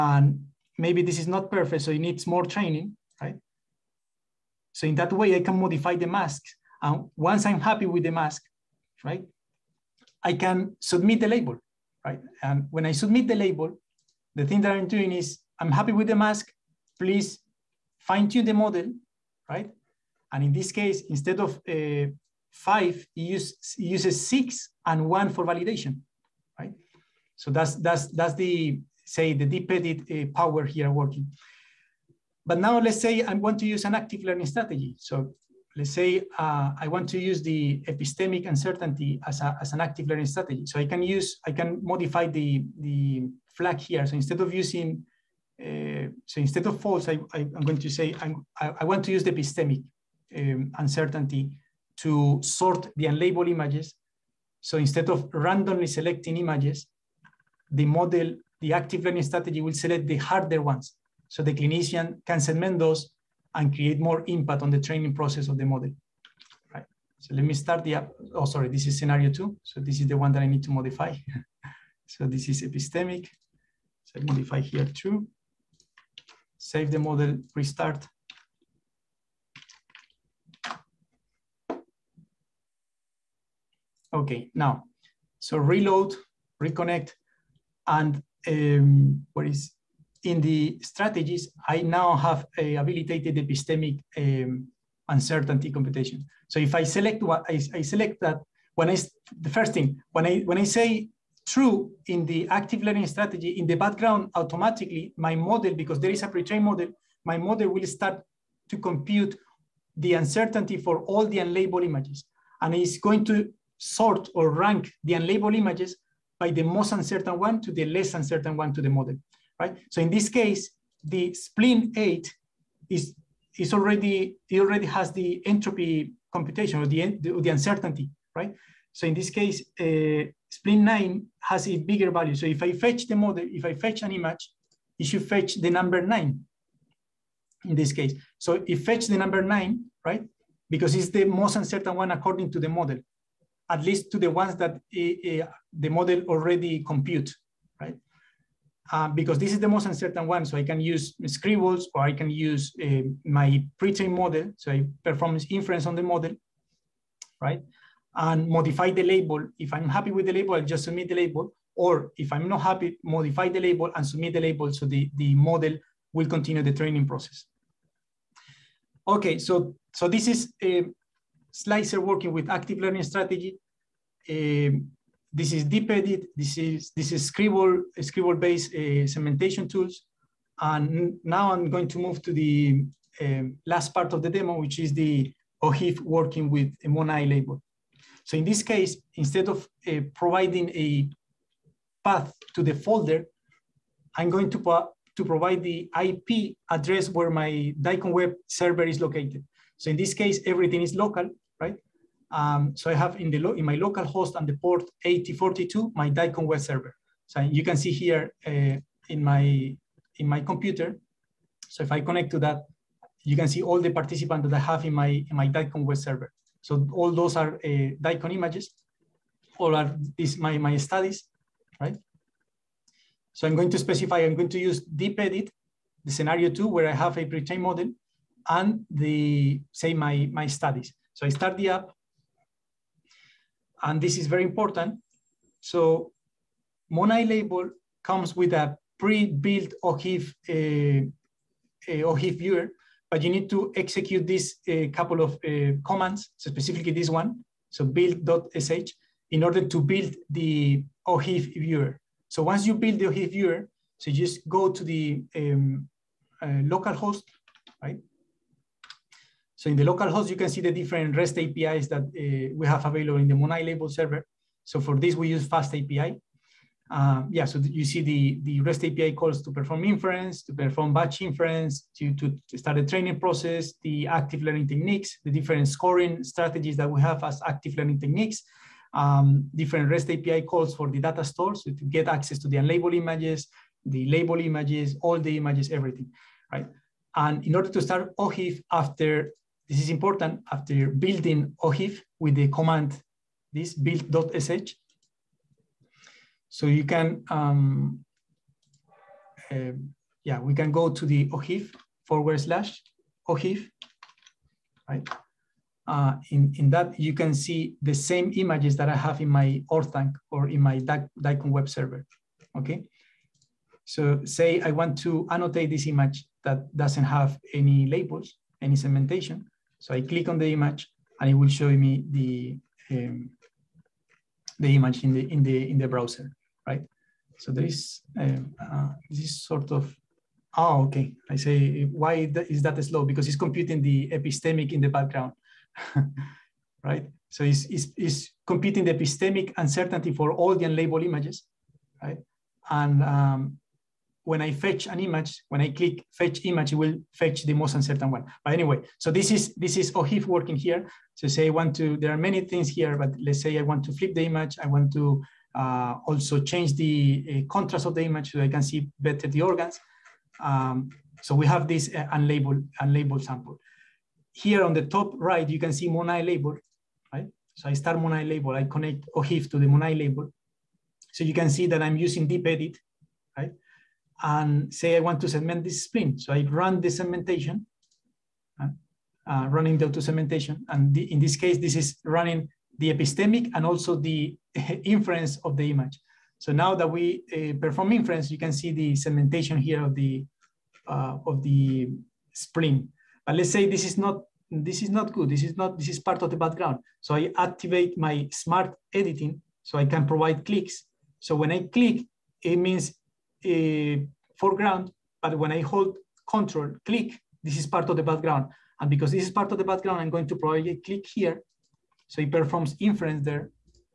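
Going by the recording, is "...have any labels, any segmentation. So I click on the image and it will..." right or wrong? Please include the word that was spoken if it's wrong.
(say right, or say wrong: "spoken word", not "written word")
right.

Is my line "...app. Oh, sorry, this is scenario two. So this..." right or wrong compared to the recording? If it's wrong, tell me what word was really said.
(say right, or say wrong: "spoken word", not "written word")
right.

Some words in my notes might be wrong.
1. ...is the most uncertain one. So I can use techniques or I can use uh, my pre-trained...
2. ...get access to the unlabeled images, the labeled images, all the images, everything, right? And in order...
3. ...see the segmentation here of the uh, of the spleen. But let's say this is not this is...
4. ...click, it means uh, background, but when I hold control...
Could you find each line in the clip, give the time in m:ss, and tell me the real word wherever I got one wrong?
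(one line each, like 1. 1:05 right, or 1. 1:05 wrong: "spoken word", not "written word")
1. 2:29 wrong: "scribbles", not "techniques"
2. 4:41 right
3. 6:28 right
4. 6:41 wrong: "foreground", not "background".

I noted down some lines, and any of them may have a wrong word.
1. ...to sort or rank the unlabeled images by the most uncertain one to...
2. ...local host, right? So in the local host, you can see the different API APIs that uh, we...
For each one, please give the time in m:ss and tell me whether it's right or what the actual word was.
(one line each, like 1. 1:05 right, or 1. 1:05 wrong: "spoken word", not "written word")
1. 1:53 right
2. 4:16 wrong: "REST", not "API".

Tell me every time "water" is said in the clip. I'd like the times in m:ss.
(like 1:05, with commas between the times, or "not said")
not said.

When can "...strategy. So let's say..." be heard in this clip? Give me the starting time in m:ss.
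0:34.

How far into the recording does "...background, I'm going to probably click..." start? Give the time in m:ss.
6:49.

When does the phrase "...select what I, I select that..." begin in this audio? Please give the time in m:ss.
1:36.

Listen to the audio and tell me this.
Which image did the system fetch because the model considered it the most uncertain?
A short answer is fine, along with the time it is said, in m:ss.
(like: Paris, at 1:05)
spleen 9, at 2:10.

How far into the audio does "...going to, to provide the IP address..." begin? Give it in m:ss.
3:14.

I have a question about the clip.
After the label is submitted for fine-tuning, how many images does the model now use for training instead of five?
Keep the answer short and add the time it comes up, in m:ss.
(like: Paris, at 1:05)
6, at 0:24.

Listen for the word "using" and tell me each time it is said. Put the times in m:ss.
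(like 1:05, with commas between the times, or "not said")
0:44, 6:11.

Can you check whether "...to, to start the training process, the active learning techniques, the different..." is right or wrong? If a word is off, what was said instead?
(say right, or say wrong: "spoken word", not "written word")
right.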